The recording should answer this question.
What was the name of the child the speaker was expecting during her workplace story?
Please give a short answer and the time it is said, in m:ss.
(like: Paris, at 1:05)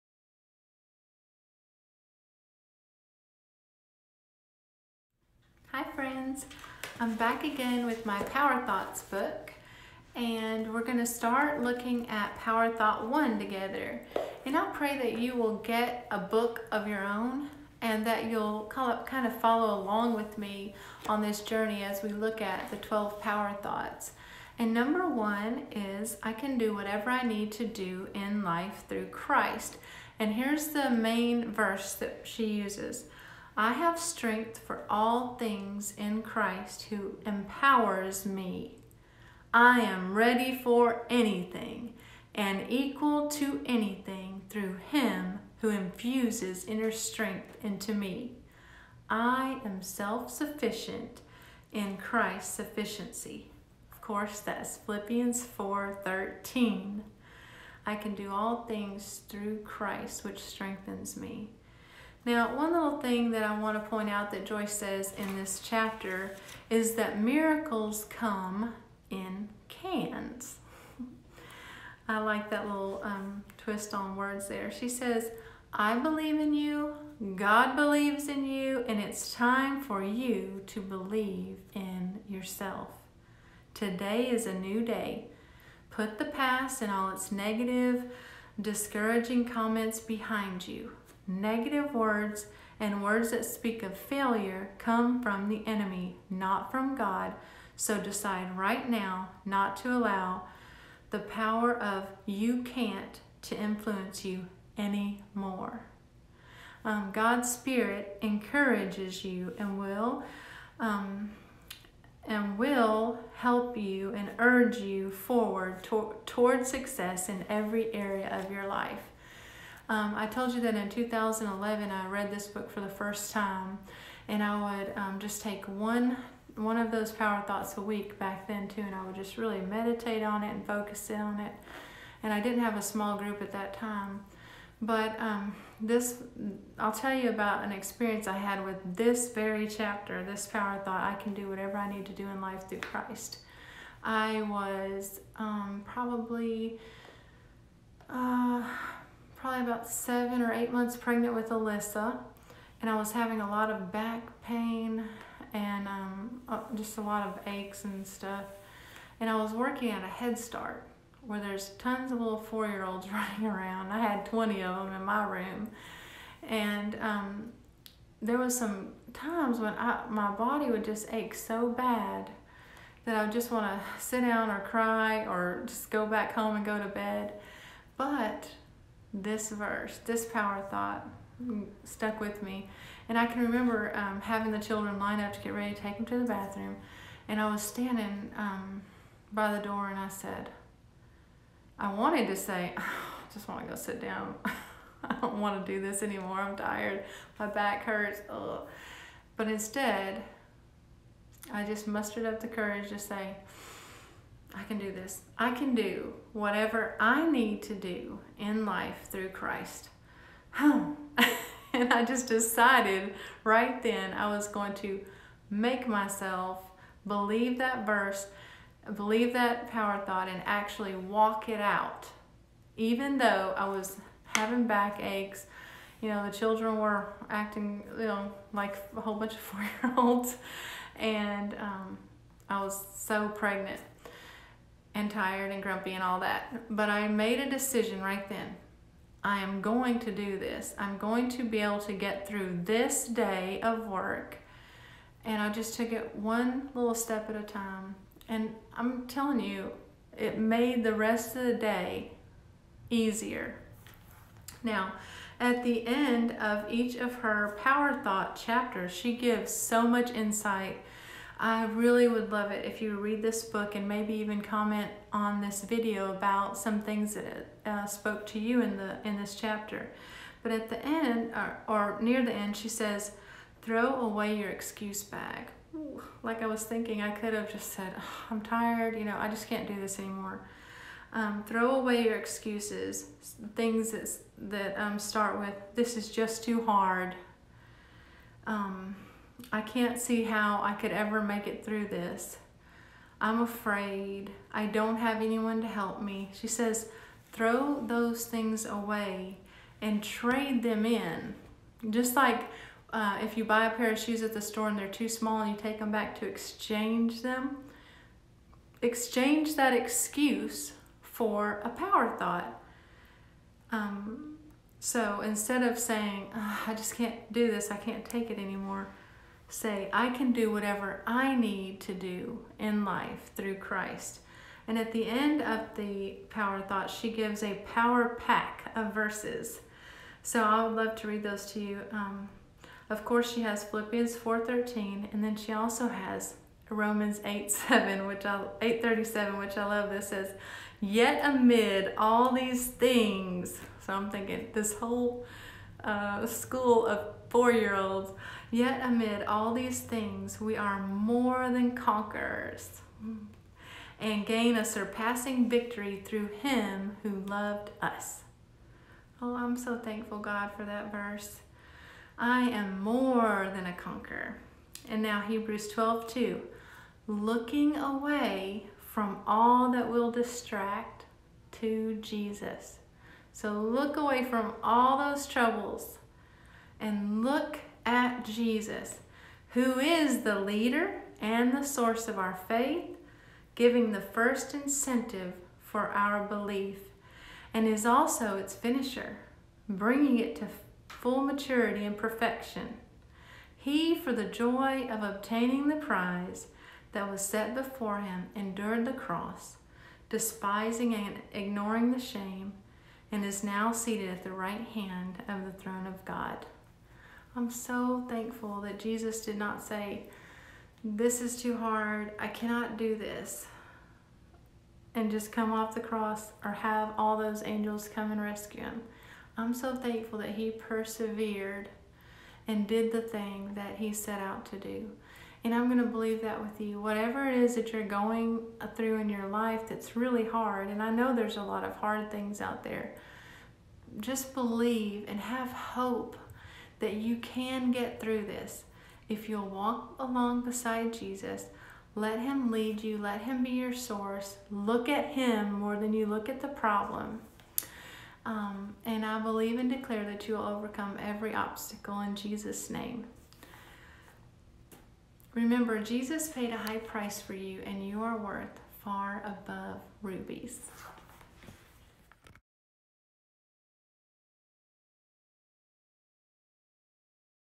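Alyssa, at 2:31.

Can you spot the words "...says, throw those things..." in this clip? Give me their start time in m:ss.
4:56.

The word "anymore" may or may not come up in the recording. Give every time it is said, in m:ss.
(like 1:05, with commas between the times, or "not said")
1:44, 3:16, 4:39, 5:18.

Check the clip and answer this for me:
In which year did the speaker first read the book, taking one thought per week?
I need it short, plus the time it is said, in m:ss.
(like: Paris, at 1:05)
2011, at 2:00.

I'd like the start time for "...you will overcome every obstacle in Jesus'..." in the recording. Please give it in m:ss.
7:30.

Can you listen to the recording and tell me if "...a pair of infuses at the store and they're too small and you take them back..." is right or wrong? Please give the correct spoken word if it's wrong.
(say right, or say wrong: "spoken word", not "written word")
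wrong: "shoes", not "infuses".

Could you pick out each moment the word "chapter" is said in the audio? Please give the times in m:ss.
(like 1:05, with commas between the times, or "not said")
1:05, 2:19, 4:18, 4:29.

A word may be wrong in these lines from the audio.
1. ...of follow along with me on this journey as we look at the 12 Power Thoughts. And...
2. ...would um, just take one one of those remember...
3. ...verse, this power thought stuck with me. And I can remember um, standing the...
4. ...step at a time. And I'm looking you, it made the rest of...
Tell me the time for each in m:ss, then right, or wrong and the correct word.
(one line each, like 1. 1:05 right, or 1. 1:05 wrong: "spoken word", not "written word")
1. 0:19 right
2. 2:04 wrong: "power", not "remember"
3. 2:59 wrong: "having", not "standing"
4. 4:06 wrong: "telling", not "looking".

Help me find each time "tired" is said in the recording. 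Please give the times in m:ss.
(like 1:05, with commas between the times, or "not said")
3:16, 3:55, 4:38.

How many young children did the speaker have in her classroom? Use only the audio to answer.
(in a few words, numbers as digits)
20.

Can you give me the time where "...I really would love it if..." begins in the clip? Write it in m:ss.
4:21.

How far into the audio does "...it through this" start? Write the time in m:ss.
4:51.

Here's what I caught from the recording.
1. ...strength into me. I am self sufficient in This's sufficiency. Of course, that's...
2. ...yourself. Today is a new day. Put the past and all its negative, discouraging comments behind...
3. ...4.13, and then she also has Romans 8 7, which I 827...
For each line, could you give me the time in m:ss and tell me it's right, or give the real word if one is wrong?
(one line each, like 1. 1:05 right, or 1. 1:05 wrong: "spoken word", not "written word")
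1. 0:46 wrong: "Christ", not "This"
2. 1:22 right
3. 5:34 wrong: "837", not "827".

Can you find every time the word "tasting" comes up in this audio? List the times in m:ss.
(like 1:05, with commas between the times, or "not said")
not said.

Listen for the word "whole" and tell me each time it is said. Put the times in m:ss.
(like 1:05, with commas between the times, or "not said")
3:49, 5:44.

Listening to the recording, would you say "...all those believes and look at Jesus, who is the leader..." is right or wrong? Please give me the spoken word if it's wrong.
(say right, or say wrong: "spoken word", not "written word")
wrong: "troubles", not "believes".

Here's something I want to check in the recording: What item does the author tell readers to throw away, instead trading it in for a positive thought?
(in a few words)
excuse bag.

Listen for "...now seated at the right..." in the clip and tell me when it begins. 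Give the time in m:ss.
6:43.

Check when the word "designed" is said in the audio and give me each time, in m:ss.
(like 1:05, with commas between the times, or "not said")
not said.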